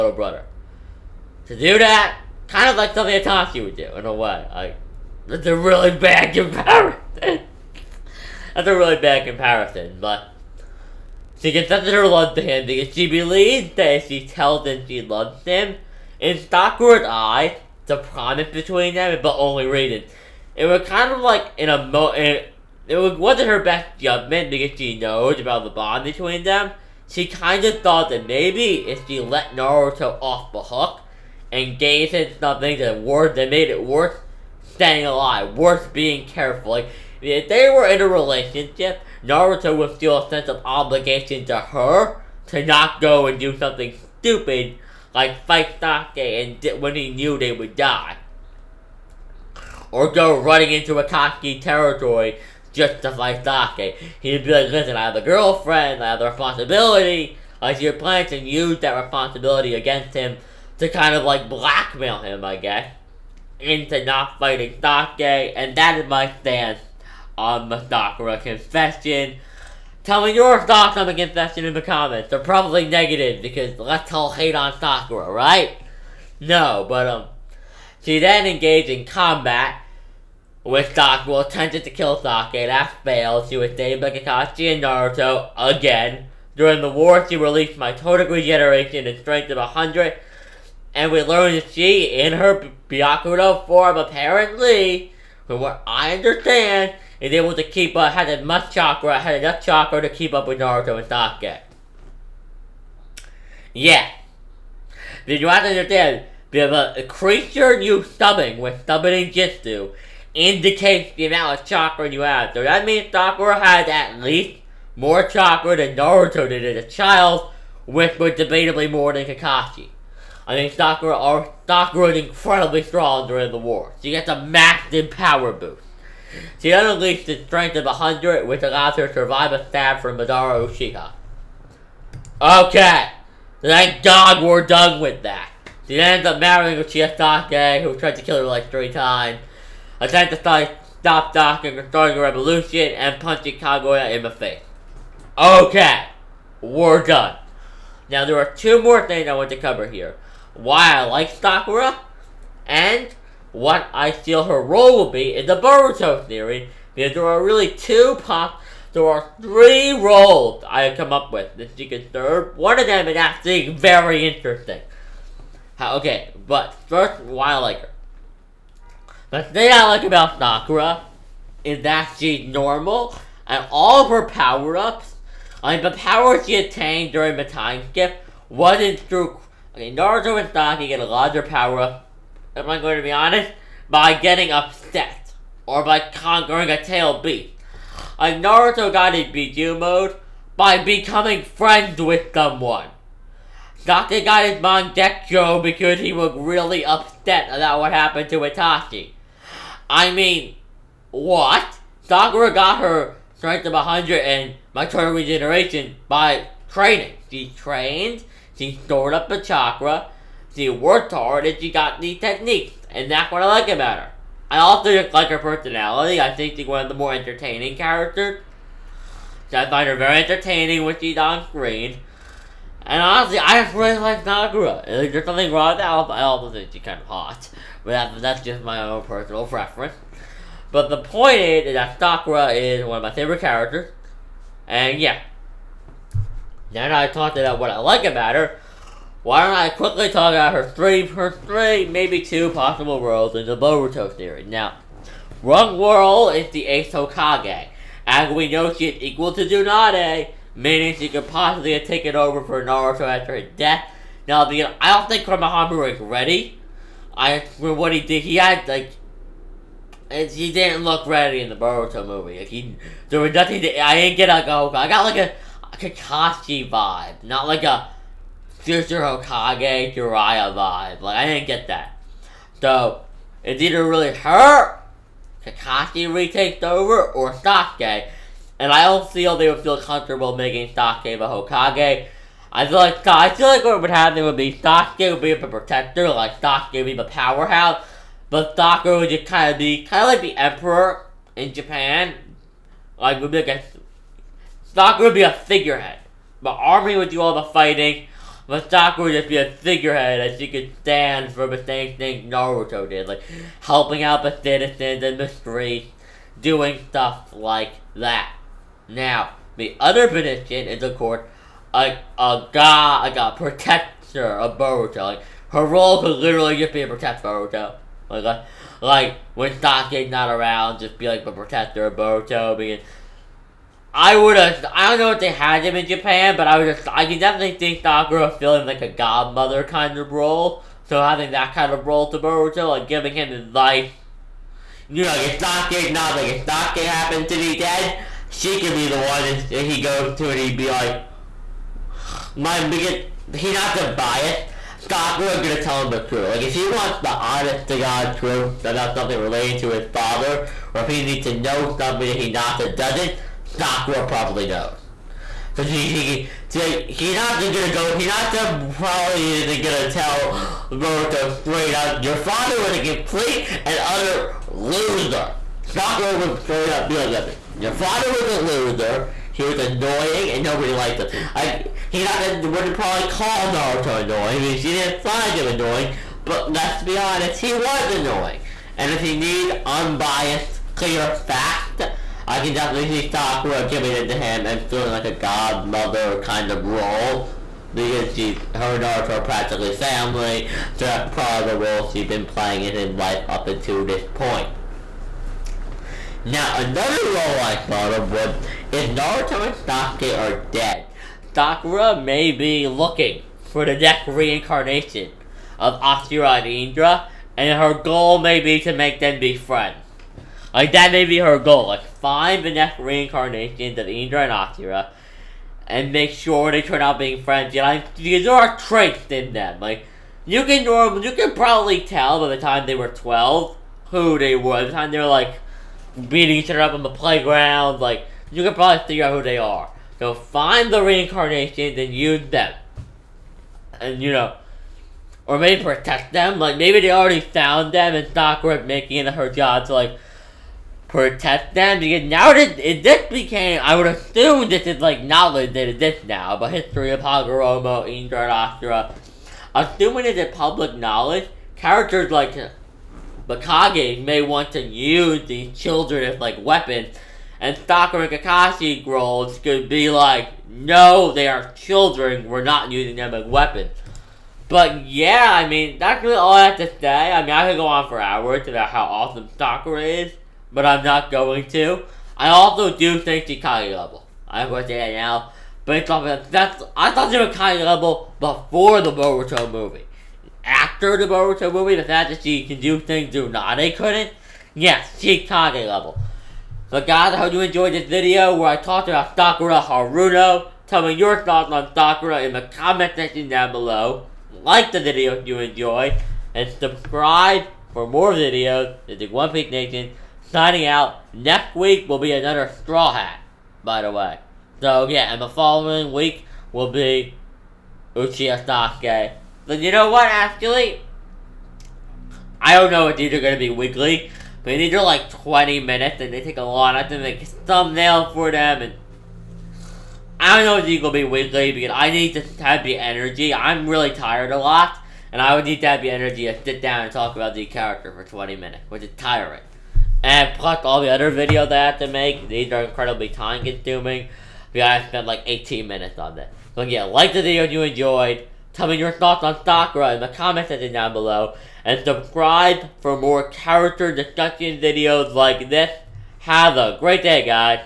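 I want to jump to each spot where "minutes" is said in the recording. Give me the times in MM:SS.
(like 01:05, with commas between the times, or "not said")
08:35, 08:48, 08:55.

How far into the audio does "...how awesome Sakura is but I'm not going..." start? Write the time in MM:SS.
07:48.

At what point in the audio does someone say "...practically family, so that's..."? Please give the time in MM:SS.
06:29.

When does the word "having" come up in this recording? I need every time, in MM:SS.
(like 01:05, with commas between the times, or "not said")
05:31.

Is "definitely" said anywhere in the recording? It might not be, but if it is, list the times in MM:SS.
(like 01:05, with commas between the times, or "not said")
05:27, 06:22.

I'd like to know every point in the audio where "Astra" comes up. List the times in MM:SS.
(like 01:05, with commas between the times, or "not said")
07:28.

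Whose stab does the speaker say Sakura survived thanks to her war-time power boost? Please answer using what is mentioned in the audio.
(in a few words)
Madara Uchiha.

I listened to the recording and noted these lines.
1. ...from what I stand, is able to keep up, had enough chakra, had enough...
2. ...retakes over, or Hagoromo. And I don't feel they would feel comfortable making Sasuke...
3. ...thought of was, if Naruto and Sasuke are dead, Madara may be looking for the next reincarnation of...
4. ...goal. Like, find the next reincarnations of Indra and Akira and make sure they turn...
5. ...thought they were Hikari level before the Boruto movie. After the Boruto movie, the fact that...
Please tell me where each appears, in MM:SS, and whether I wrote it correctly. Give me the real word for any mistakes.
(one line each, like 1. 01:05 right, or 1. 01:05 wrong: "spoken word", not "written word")
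1. 01:35 wrong: "understand", not "stand"
2. 04:36 wrong: "Sasuke", not "Hagoromo"
3. 06:37 wrong: "Sakura", not "Madara"
4. 06:51 right
5. 07:56 right.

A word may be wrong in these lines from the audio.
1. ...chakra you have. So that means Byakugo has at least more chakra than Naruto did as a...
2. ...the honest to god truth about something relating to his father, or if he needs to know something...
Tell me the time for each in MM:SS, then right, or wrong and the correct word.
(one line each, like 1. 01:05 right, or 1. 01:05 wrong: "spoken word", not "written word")
1. 01:51 wrong: "Sakura", not "Byakugo"
2. 05:46 right.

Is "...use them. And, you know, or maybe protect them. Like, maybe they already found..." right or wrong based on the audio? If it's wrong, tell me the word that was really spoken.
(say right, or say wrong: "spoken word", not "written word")
right.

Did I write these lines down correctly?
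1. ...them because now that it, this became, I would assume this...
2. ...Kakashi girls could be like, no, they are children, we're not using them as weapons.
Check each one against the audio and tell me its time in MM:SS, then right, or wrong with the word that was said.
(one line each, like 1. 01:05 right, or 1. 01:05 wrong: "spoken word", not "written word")
1. 07:21 right
2. 07:38 right.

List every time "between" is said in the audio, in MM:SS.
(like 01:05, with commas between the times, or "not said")
00:18, 00:26.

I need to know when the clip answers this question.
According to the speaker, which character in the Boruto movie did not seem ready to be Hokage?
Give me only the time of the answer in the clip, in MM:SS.
04:15.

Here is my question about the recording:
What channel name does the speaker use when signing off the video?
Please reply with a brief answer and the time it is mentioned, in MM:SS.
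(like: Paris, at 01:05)
One Piece Nation, at 08:19.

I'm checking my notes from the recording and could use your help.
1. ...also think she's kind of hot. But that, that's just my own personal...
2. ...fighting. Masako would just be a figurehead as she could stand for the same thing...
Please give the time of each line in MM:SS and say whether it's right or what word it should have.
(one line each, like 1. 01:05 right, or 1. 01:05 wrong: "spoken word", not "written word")
1. 03:46 right
2. 04:57 right.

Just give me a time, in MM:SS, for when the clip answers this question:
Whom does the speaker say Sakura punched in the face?
02:23.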